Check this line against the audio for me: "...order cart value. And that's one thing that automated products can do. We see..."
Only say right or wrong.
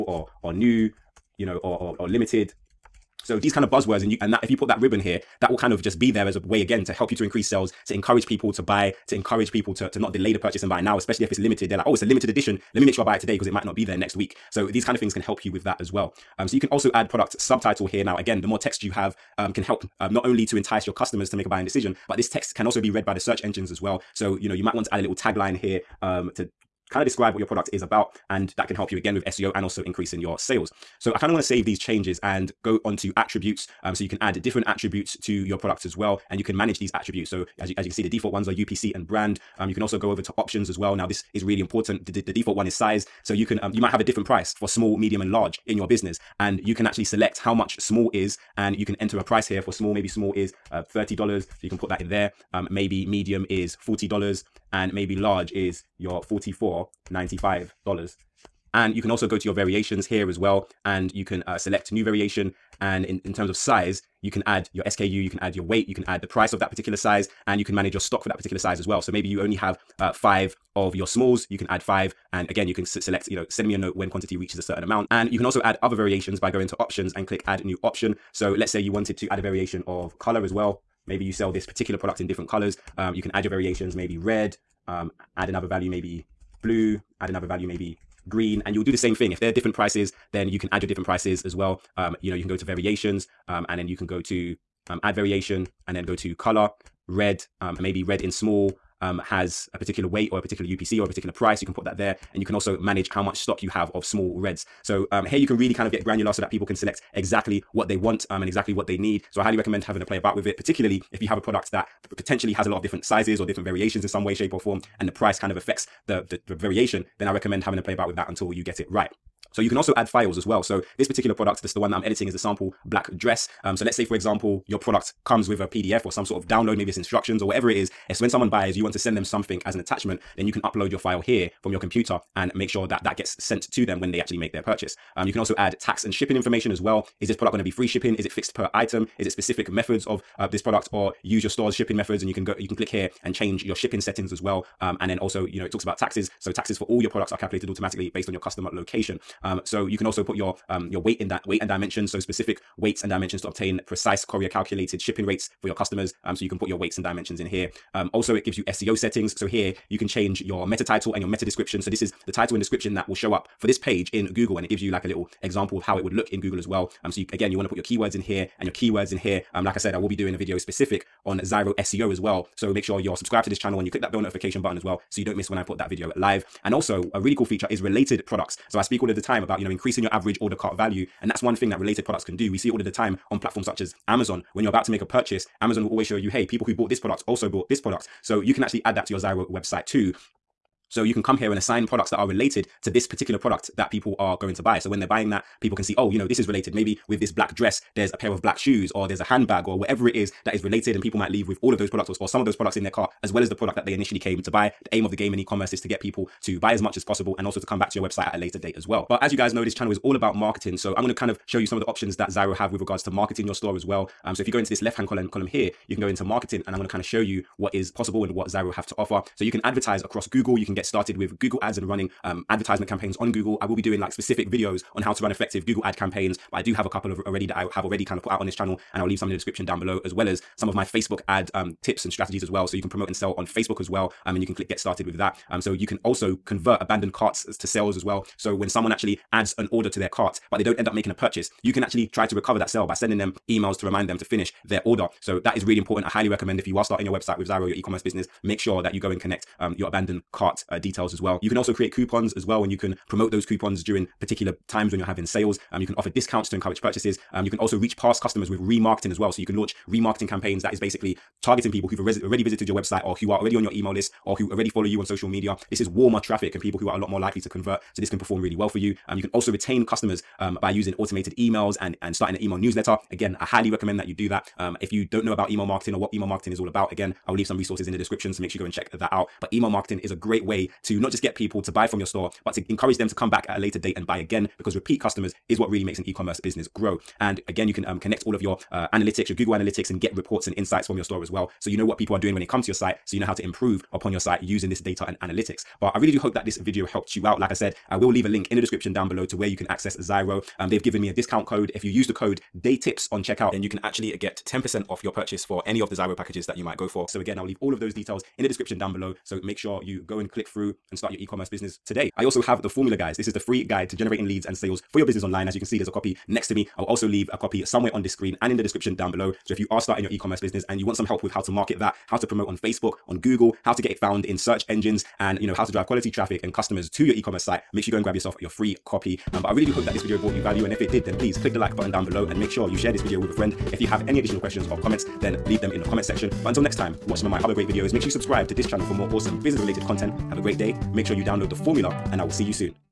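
wrong.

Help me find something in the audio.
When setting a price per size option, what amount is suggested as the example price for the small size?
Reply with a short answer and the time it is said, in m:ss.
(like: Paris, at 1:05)
$30, at 0:50.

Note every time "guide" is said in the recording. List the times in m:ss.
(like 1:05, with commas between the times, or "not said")
5:13.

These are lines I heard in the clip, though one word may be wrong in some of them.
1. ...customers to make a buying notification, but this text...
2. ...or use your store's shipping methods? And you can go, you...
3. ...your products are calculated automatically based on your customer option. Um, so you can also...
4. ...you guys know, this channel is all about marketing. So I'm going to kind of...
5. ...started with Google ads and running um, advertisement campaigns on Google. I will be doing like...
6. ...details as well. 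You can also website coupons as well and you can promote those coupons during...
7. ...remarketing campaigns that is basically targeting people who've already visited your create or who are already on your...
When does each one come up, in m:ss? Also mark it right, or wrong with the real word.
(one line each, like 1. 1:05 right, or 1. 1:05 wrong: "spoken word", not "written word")
1. 0:20 wrong: "decision", not "notification"
2. 2:20 right
3. 2:27 wrong: "location", not "option"
4. 3:29 right
5. 3:40 right
6. 4:10 wrong: "create", not "website"
7. 4:19 wrong: "website", not "create".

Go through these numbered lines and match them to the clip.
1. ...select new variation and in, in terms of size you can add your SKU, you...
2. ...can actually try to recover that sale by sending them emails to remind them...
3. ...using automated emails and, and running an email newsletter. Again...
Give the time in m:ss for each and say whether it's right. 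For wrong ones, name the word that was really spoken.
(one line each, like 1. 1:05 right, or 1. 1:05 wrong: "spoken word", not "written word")
1. 1:01 right
2. 4:01 right
3. 4:30 wrong: "starting", not "running".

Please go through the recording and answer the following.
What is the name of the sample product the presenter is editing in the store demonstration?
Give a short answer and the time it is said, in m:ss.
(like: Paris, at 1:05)
sample black dress, at 2:02.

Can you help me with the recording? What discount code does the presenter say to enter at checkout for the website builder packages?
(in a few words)
DeyTips.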